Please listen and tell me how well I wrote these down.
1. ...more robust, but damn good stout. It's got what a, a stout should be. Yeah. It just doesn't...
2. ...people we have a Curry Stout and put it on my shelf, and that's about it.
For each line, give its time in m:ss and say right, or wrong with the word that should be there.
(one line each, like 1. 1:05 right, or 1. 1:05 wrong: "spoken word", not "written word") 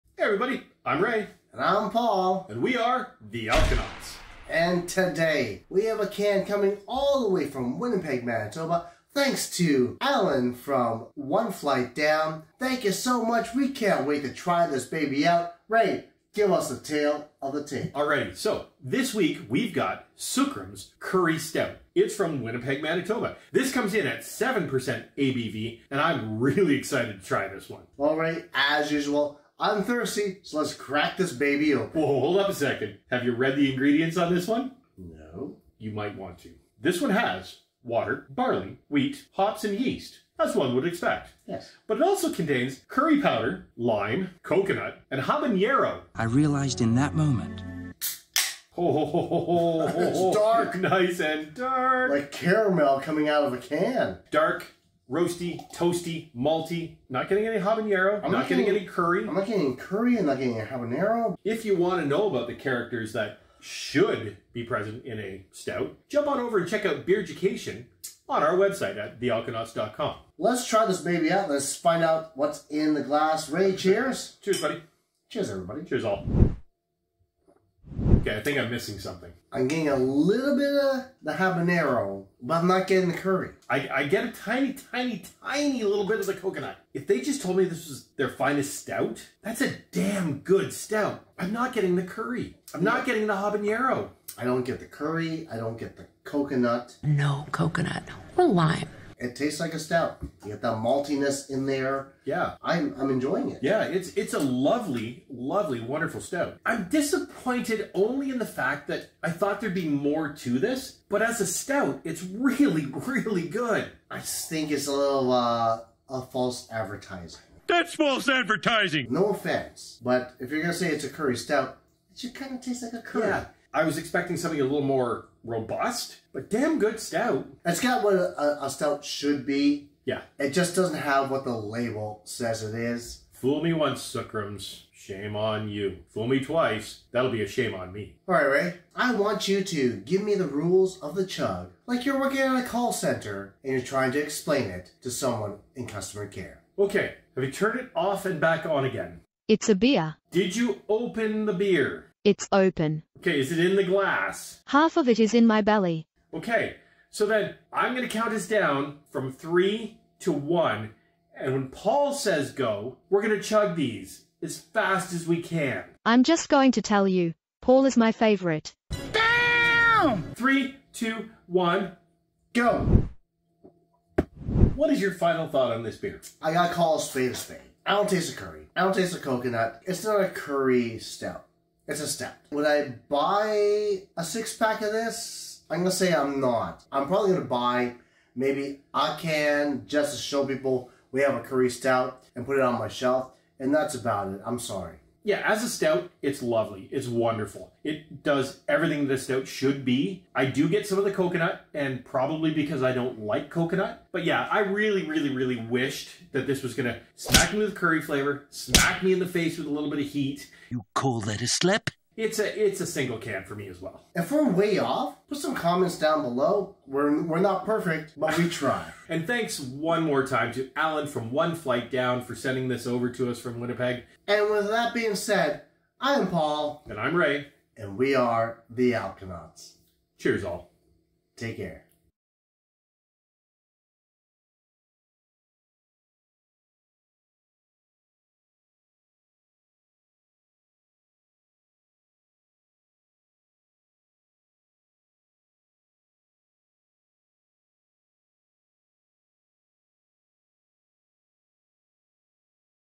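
1. 2:04 right
2. 3:10 right.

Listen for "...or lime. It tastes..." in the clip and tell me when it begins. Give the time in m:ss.
1:38.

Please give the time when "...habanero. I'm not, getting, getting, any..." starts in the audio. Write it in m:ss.
0:57.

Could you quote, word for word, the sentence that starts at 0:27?
All right, as usual, I'm thirsty, so let's crack this baby open.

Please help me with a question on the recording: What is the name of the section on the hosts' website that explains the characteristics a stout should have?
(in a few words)
Beer Education.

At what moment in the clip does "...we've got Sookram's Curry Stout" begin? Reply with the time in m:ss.
0:19.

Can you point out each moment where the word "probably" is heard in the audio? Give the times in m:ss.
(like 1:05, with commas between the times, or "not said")
3:07, 3:22.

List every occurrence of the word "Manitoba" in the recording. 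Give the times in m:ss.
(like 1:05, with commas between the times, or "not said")
0:08, 0:22.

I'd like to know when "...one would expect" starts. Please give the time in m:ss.
0:40.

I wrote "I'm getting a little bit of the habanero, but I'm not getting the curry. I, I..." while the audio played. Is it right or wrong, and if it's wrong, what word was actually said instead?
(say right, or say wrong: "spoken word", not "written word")
right.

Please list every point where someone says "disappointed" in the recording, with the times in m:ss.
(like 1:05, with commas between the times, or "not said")
1:46.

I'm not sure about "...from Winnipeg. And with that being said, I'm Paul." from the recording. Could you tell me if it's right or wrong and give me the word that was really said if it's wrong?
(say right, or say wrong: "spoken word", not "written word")
right.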